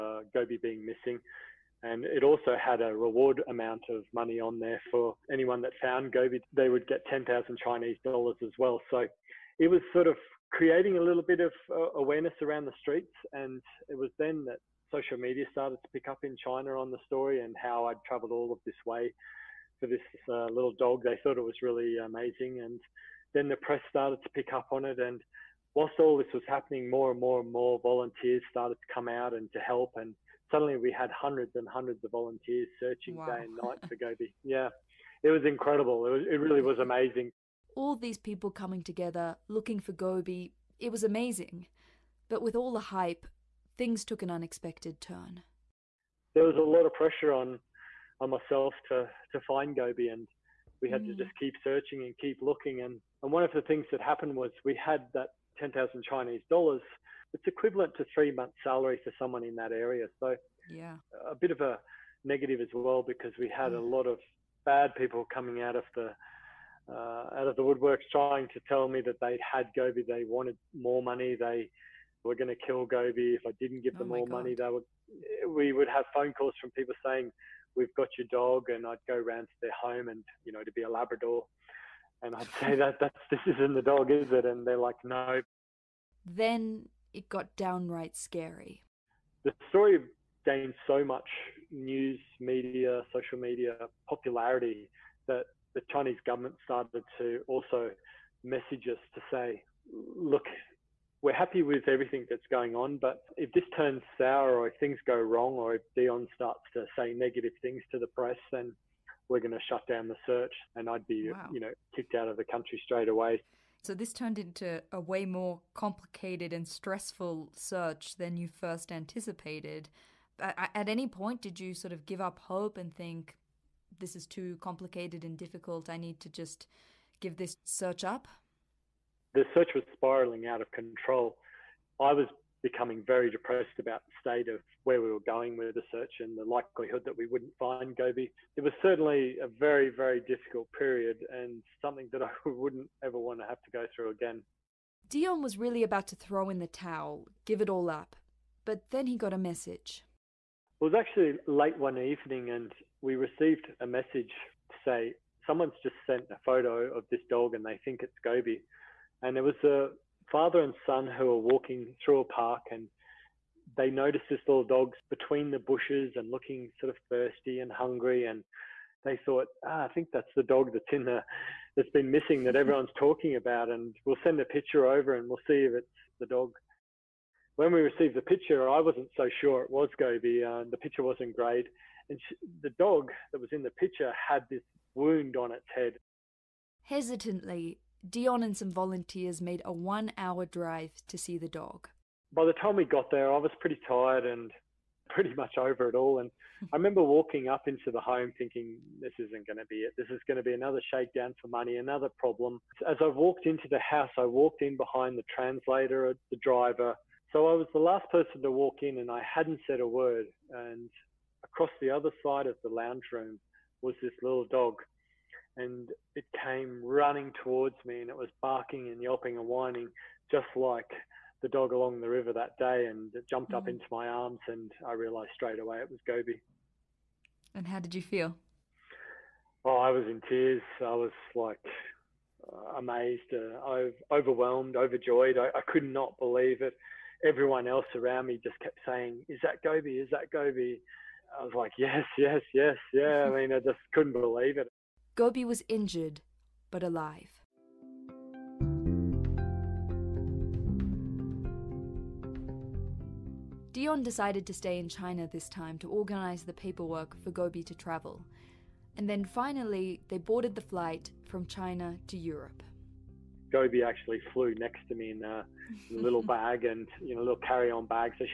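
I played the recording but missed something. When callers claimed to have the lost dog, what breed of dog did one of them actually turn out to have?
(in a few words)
Labrador.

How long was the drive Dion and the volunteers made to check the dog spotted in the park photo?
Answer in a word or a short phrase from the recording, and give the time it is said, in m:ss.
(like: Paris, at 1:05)
1 hour, at 3:09.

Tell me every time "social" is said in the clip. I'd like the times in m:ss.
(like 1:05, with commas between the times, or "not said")
0:14, 1:33.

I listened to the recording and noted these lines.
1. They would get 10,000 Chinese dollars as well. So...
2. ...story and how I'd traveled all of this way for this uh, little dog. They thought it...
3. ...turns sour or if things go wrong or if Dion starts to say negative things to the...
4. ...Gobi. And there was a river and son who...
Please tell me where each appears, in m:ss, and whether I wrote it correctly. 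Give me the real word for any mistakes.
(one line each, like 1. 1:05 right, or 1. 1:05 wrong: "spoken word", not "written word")
1. 0:06 right
2. 0:17 right
3. 1:43 right
4. 2:38 wrong: "father", not "river".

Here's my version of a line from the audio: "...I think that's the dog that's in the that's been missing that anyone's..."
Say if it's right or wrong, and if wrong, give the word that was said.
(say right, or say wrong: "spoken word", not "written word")
wrong: "everyone", not "anyone".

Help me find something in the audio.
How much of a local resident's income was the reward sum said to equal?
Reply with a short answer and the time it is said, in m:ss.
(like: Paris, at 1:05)
3 months' salary, at 0:58.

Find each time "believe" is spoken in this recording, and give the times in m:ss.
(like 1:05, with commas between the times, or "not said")
3:56, 4:04.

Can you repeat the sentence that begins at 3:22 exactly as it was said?
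As I walked into the house, I walked in behind the translator, the driver.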